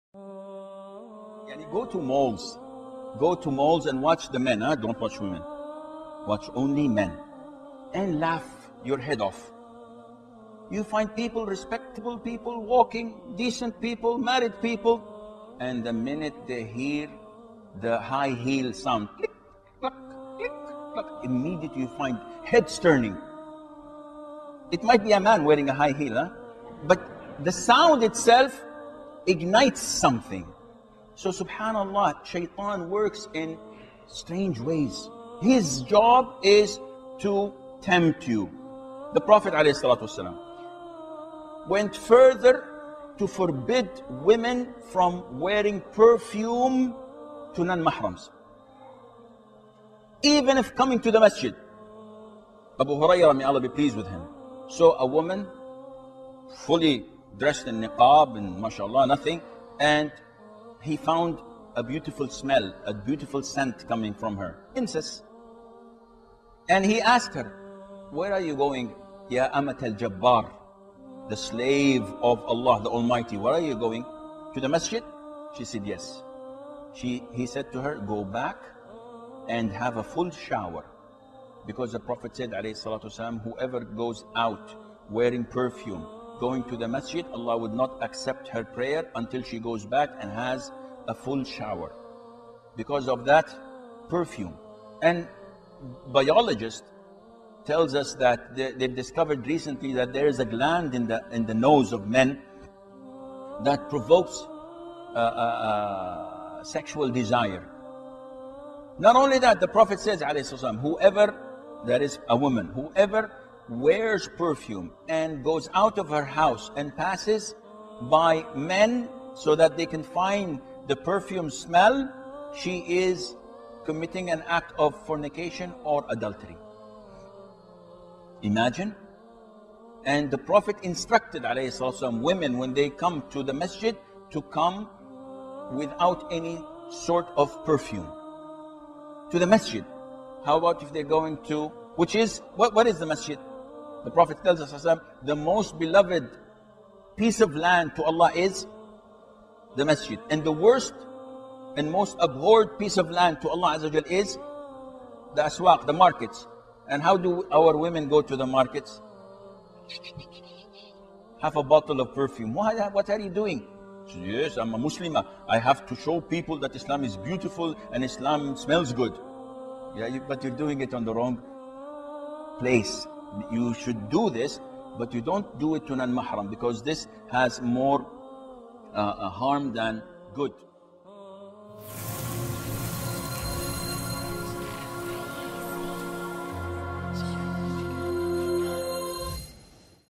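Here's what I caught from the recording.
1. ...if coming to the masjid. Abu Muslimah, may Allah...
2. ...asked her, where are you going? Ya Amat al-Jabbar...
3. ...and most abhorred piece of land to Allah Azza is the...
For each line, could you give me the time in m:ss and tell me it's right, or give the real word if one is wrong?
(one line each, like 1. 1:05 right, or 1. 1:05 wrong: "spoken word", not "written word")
1. 0:50 wrong: "Hurairah", not "Muslimah"
2. 1:07 right
3. 2:31 right.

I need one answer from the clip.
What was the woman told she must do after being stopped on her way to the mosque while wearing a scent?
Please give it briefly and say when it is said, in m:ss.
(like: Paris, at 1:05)
have a full shower, at 1:19.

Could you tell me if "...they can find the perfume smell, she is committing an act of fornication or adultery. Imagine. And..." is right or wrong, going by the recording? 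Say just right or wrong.
right.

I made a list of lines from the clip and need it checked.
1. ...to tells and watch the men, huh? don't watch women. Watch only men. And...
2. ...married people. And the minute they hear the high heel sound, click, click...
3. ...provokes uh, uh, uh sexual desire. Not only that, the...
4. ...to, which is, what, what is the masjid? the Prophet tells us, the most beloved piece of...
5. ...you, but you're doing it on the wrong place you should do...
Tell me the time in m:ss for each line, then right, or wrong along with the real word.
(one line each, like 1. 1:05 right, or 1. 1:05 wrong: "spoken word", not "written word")
1. 0:03 wrong: "malls", not "tells"
2. 0:14 right
3. 1:43 right
4. 2:21 right
5. 2:50 right.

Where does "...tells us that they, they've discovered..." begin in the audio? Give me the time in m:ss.
1:37.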